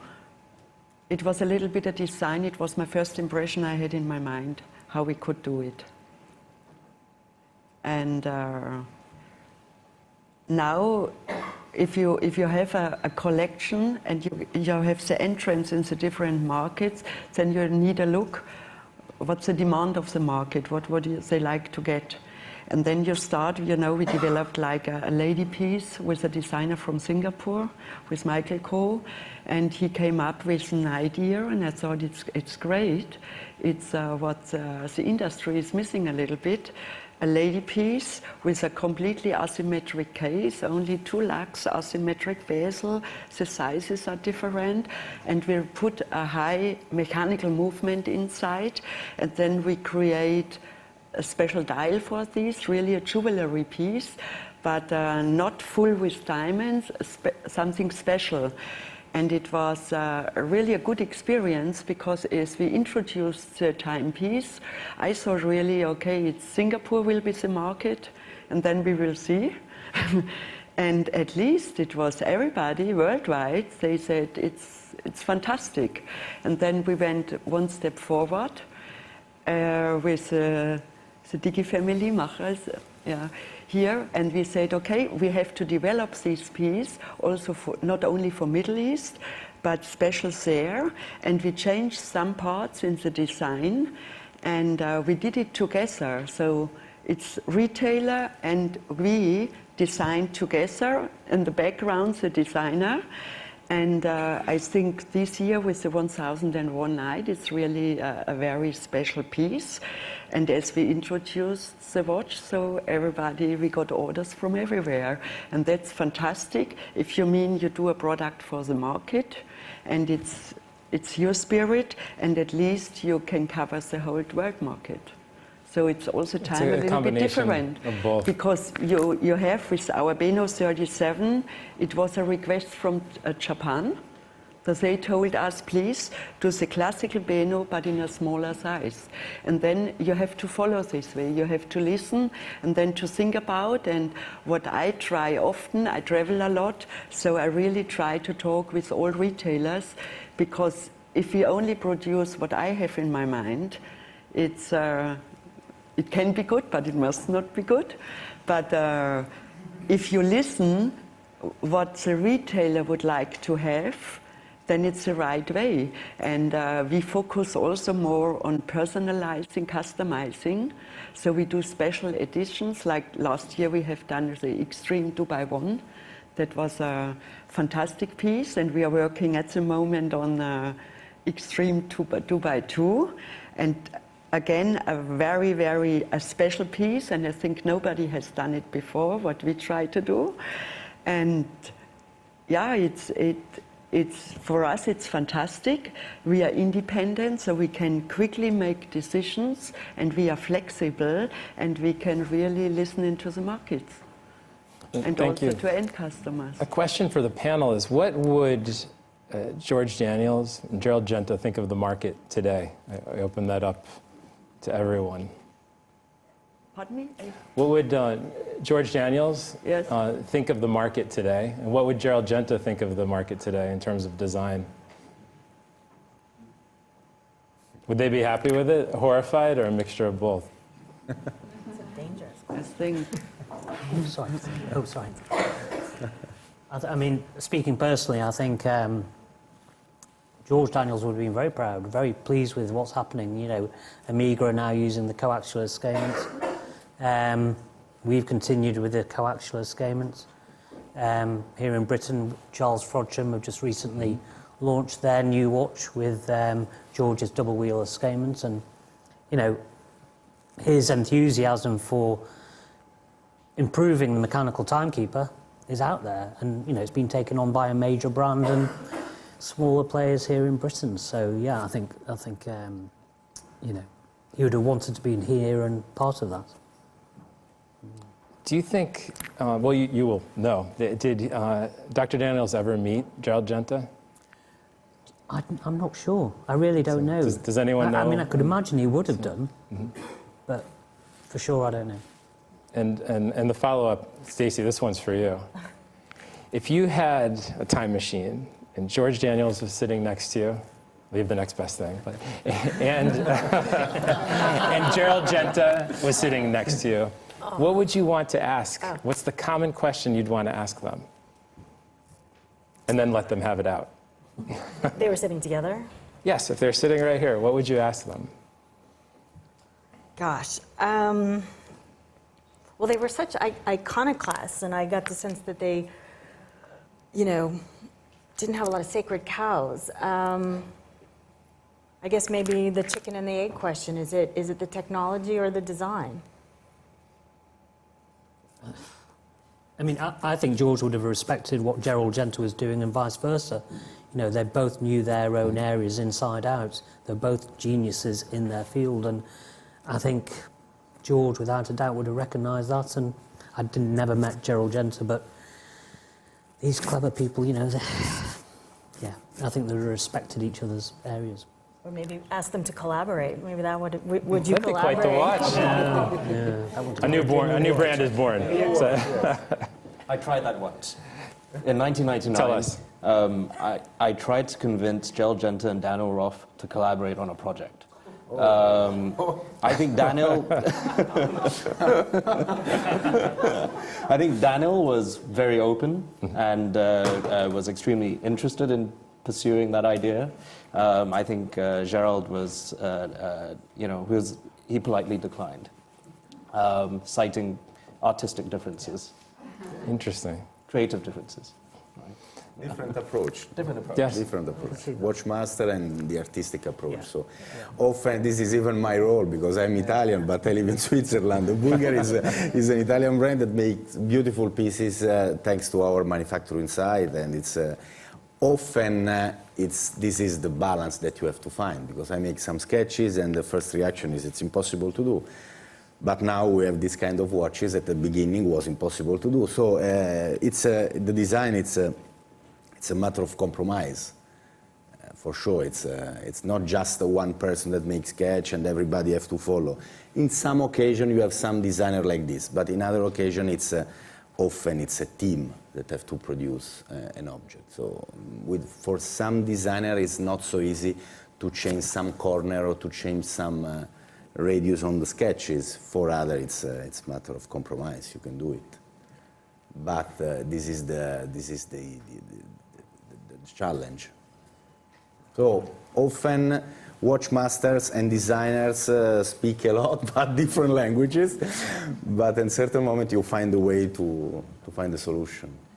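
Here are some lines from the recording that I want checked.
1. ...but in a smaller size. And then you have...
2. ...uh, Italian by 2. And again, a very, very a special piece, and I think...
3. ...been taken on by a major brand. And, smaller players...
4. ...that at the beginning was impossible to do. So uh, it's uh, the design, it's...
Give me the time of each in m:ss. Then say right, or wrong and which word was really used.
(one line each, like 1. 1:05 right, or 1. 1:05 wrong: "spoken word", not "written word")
1. 2:17 right
2. 3:00 wrong: "Extreme", not "Italian"
3. 4:26 right
4. 7:07 right.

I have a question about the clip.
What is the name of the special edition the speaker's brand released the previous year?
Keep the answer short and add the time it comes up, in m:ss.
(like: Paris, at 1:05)
Extreme two by One, at 2:54.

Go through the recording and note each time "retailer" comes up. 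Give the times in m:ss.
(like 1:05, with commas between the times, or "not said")
1:37, 2:29, 2:42.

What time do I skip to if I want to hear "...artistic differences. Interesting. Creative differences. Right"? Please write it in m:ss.
6:38.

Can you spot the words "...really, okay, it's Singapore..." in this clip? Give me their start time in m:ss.
1:05.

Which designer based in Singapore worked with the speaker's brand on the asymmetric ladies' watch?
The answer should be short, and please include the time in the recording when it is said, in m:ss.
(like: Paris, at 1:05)
Michael Cole, at 0:28.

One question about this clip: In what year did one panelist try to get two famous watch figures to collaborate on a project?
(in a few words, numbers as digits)
1999.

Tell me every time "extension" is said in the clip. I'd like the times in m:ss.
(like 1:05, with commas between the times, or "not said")
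not said.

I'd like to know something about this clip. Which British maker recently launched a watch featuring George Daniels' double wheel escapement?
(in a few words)
Charles Frodsham.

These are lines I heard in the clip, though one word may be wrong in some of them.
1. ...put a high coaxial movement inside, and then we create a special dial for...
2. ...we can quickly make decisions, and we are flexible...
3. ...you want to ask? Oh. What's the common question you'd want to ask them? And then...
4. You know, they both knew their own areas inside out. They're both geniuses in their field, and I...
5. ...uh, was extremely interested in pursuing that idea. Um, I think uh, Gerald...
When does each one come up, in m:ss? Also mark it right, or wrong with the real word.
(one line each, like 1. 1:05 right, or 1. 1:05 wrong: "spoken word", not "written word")
1. 0:45 wrong: "mechanical", not "coaxial"
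2. 3:17 right
3. 5:07 right
4. 5:43 right
5. 6:26 right.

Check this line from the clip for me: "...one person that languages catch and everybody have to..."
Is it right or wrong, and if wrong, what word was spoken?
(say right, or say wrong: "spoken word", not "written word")
wrong: "makes", not "languages".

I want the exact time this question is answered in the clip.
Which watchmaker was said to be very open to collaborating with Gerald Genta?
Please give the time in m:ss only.
6:15.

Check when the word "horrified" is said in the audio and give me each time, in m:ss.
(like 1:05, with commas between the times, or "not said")
3:48.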